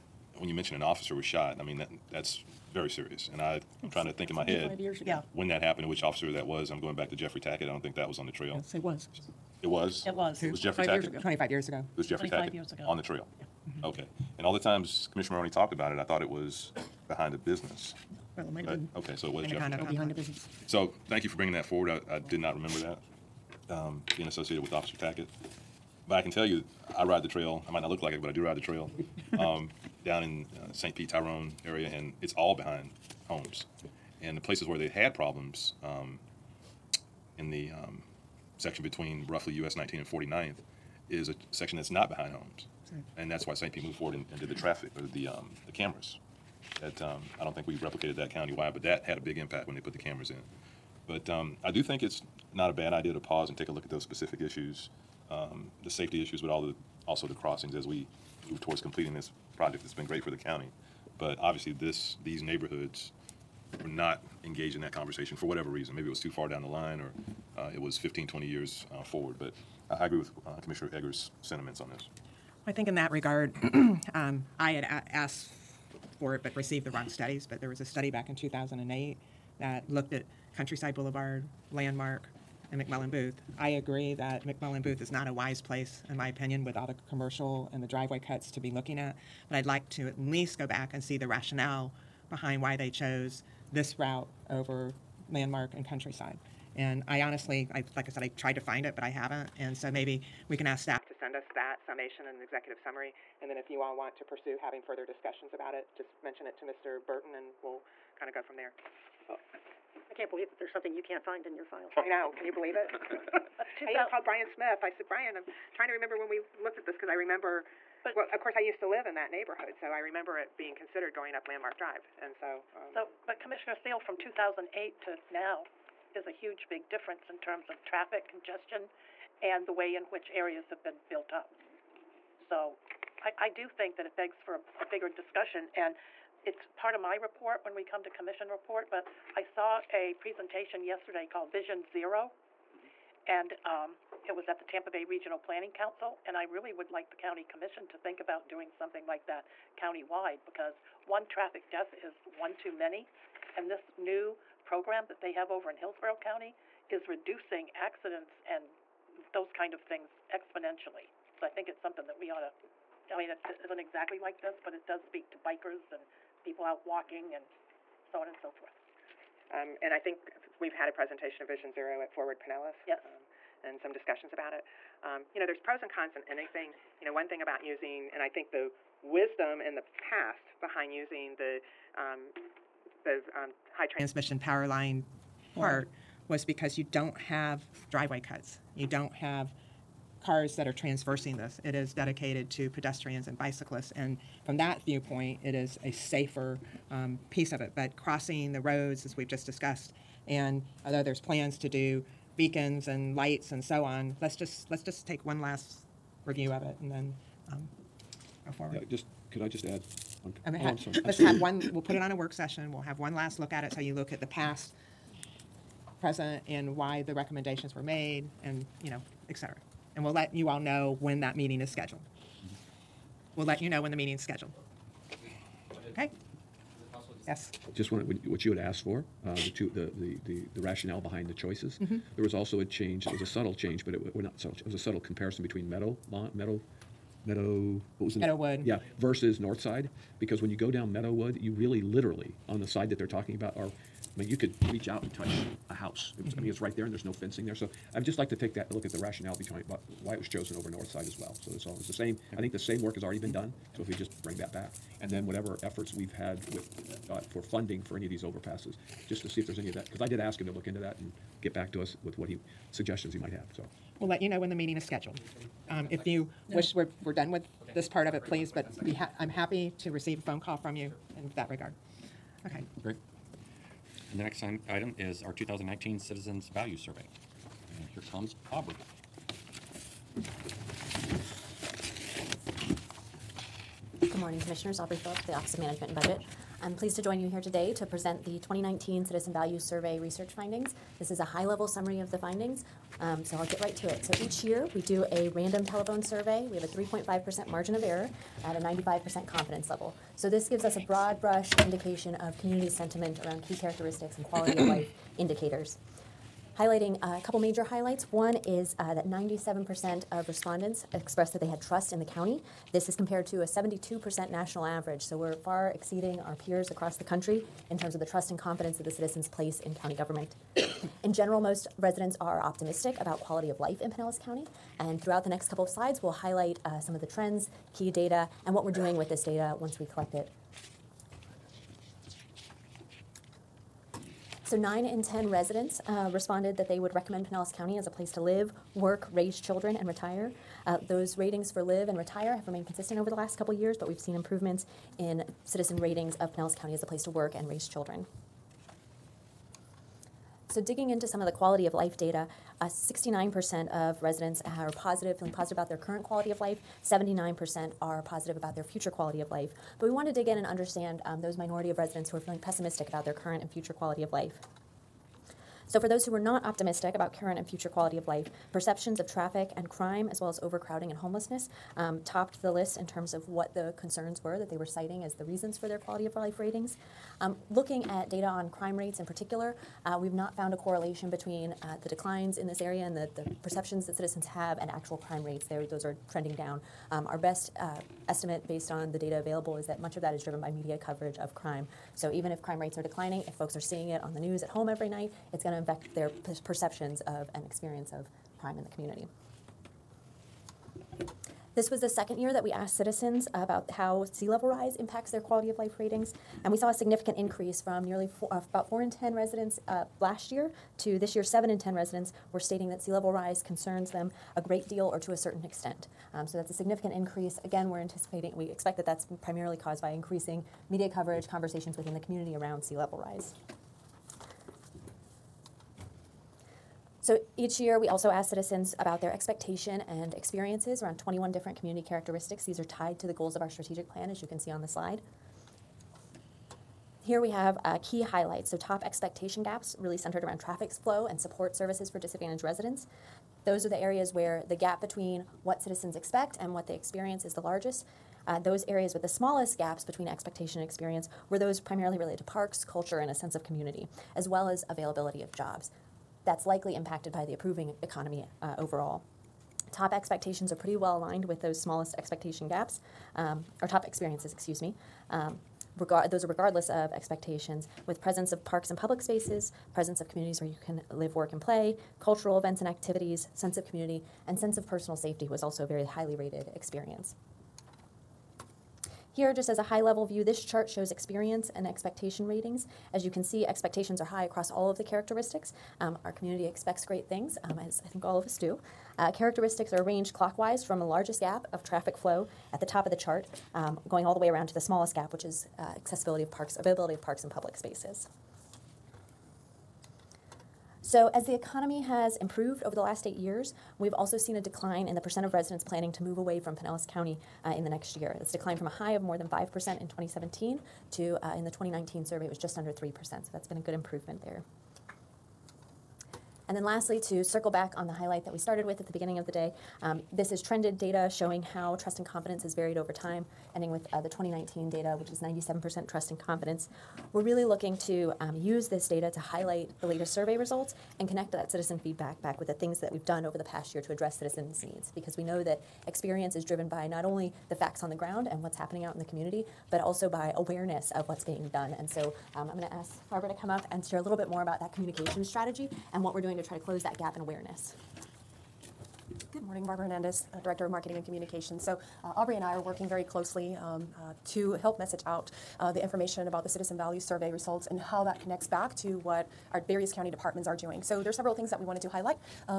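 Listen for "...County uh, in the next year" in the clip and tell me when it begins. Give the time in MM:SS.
08:26.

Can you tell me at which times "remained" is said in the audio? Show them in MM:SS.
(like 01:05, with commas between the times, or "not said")
05:42.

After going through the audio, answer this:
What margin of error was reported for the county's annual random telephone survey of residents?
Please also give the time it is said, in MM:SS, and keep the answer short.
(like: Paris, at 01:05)
3.5%, at 04:56.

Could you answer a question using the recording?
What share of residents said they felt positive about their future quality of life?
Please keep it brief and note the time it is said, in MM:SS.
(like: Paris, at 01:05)
79%, at 05:56.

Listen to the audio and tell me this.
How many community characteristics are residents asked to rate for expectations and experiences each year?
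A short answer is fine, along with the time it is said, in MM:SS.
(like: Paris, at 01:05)
21, at 07:10.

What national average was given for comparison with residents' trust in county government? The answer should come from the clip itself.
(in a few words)
72%.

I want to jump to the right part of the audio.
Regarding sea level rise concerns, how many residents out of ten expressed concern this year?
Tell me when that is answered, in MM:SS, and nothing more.
06:51.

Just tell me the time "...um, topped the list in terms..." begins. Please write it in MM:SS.
06:11.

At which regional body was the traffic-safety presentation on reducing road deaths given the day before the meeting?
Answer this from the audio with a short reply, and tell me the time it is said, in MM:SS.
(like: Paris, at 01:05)
Tampa Bay Regional Planning Council, at 02:24.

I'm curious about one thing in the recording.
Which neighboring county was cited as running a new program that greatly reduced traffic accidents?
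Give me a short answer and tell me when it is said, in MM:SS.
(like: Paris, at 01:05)
Hillsborough County, at 02:35.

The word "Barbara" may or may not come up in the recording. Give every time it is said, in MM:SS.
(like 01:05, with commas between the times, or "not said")
09:03, 09:09.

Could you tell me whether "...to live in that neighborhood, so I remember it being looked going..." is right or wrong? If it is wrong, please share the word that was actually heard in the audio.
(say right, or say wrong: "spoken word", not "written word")
wrong: "considered", not "looked".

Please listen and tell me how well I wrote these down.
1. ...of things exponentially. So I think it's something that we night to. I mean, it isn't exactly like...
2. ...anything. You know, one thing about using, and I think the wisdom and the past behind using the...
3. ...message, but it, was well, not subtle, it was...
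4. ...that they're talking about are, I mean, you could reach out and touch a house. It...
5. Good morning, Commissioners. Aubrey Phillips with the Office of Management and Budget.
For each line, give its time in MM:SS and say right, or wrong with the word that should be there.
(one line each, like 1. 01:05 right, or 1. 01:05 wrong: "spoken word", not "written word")
1. 02:39 wrong: "ought", not "night"
2. 02:56 right
3. 03:53 wrong: "change", not "message"
4. 04:02 right
5. 04:44 right.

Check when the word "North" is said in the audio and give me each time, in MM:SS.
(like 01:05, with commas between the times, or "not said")
03:59, 04:10.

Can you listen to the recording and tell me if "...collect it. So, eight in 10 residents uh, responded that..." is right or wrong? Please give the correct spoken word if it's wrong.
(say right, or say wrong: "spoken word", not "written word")
wrong: "nine", not "eight".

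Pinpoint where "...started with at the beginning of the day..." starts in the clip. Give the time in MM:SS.
08:38.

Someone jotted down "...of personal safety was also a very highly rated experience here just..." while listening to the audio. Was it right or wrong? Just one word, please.
right.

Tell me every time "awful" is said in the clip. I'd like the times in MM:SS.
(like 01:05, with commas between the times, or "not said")
not said.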